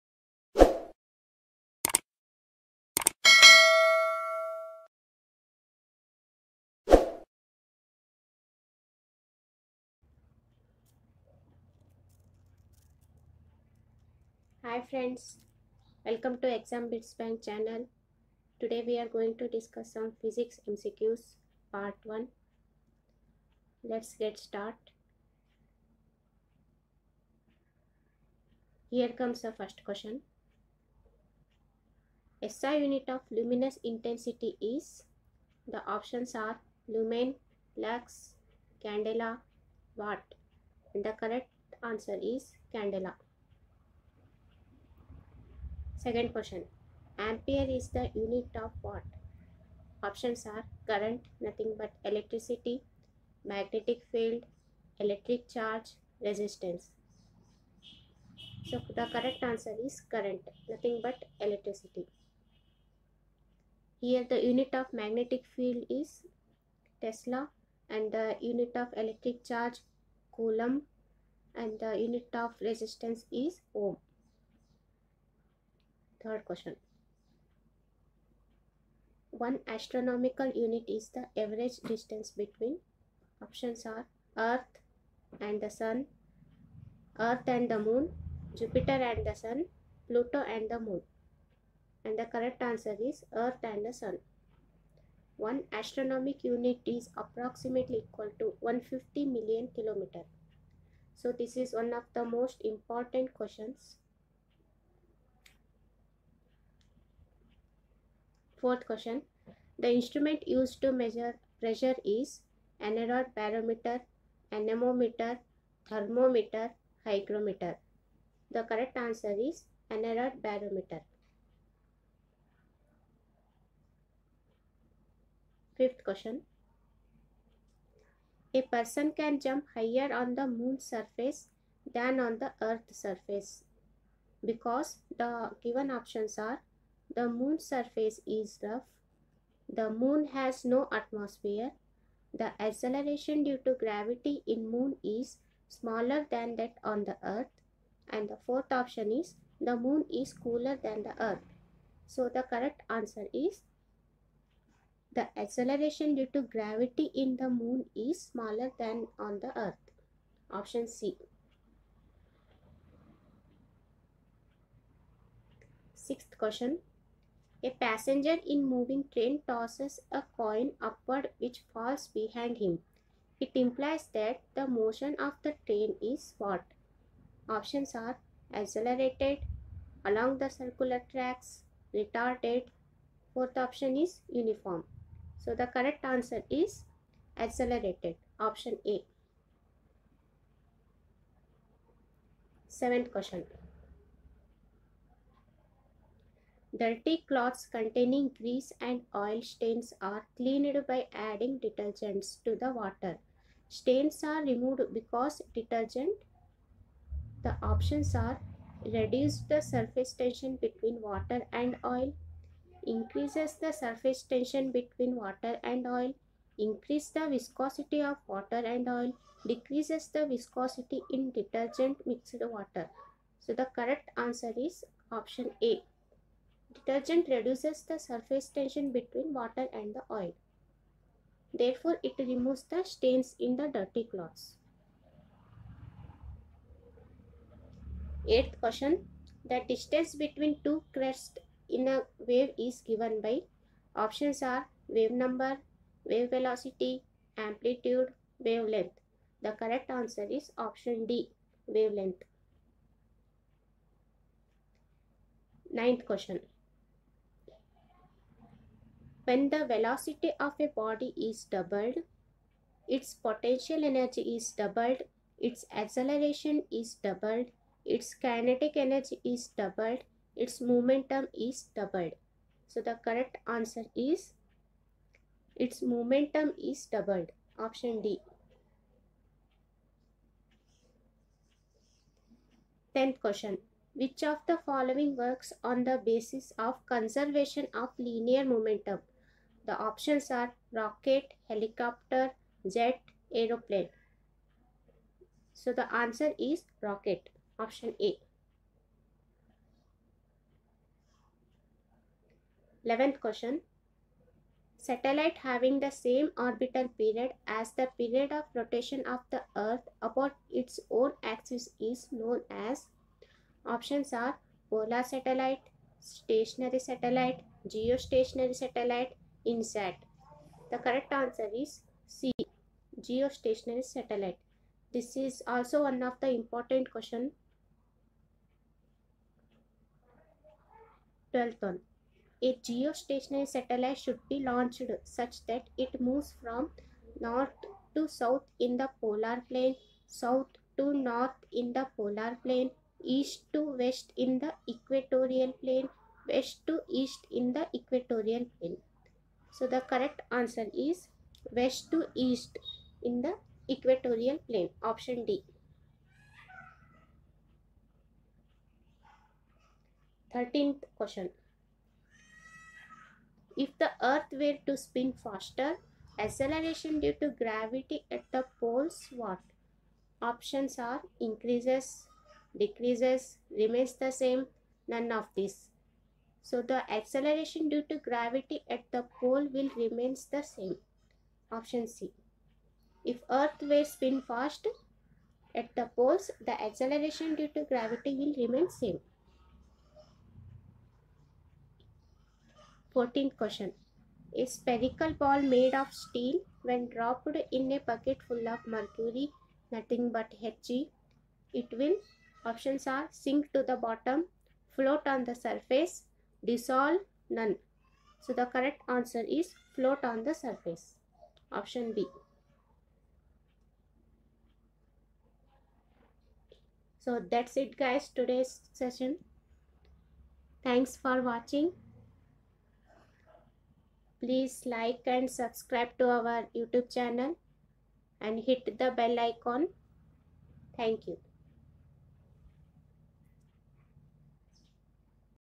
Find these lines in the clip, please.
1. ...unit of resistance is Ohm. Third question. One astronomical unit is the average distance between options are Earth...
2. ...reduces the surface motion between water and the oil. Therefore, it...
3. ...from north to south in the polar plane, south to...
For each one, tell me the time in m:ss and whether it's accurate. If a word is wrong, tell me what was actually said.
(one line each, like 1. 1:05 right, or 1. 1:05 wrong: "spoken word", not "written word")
1. 1:12 right
2. 3:47 wrong: "tension", not "motion"
3. 5:36 right.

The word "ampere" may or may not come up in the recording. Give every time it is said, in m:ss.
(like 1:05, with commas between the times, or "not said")
0:47.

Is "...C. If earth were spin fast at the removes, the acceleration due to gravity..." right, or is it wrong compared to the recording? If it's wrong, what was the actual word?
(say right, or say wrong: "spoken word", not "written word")
wrong: "poles", not "removes".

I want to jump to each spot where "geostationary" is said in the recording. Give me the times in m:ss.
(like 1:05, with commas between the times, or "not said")
5:17, 5:22, 5:32.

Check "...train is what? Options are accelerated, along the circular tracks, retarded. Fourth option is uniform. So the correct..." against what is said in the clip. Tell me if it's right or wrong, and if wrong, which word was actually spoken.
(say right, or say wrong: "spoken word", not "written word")
right.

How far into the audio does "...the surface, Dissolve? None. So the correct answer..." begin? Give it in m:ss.
6:45.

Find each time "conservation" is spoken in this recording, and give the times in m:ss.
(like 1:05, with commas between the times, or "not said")
4:46.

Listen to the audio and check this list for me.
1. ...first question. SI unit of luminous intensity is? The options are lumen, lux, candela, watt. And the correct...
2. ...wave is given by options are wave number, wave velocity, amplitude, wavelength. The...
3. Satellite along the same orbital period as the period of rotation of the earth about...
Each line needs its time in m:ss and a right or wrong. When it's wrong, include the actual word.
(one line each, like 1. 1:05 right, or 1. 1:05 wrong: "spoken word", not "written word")
1. 0:29 right
2. 4:02 right
3. 5:04 wrong: "having", not "along".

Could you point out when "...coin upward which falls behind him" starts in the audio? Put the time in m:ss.
2:50.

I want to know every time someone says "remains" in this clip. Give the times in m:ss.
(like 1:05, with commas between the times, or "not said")
6:13, 6:19, 6:28.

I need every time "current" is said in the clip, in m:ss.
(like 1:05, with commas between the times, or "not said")
0:50, 1:00.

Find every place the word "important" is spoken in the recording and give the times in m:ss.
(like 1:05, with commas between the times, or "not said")
1:42, 5:26.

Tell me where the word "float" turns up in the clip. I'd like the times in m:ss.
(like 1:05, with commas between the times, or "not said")
6:44, 6:49.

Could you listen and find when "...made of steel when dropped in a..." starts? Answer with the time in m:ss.
6:35.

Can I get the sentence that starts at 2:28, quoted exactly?
And the fourth option is the moon is cooler than the earth.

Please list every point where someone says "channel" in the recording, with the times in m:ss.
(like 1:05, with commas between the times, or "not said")
0:17, 7:06.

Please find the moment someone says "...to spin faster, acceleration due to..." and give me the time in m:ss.
6:04.